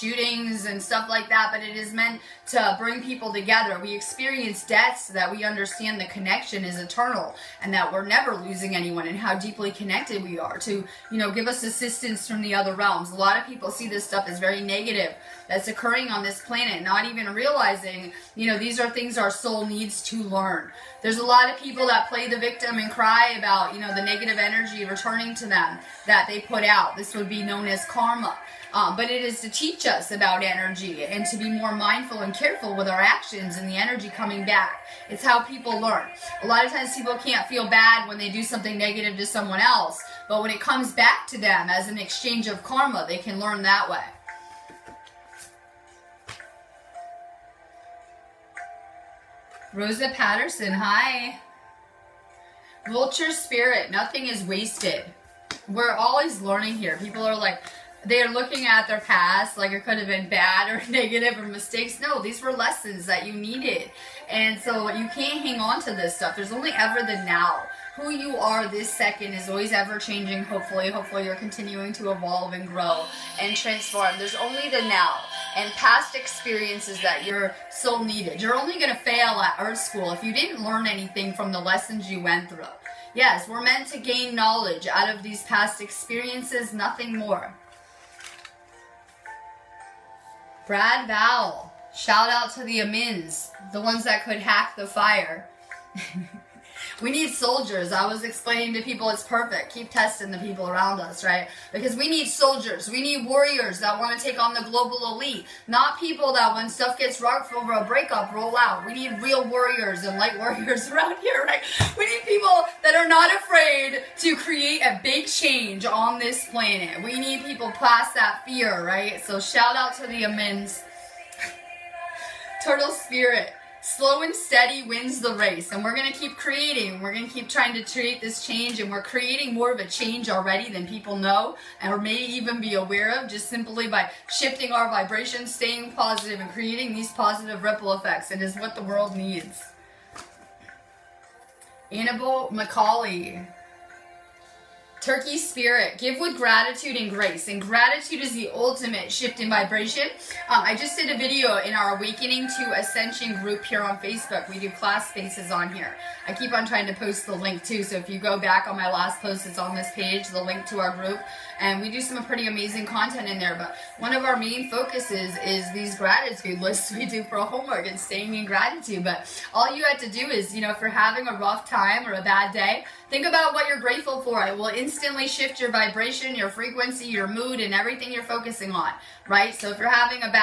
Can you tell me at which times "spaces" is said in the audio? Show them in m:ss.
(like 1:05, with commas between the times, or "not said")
2:35.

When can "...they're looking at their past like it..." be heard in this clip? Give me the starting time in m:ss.
0:58.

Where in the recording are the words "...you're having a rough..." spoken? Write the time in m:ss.
2:50.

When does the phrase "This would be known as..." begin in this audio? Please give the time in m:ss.
0:26.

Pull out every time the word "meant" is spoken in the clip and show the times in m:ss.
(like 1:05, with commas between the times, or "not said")
0:01, 1:23.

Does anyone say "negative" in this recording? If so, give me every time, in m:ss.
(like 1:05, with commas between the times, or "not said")
0:14, 0:24, 0:38, 1:00.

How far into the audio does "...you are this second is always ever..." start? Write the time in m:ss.
1:08.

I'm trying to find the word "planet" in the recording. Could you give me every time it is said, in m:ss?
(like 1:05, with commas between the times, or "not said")
0:16, 1:56.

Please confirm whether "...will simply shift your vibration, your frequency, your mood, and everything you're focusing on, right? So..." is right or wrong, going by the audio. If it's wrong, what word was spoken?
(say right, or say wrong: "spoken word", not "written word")
wrong: "instantly", not "simply".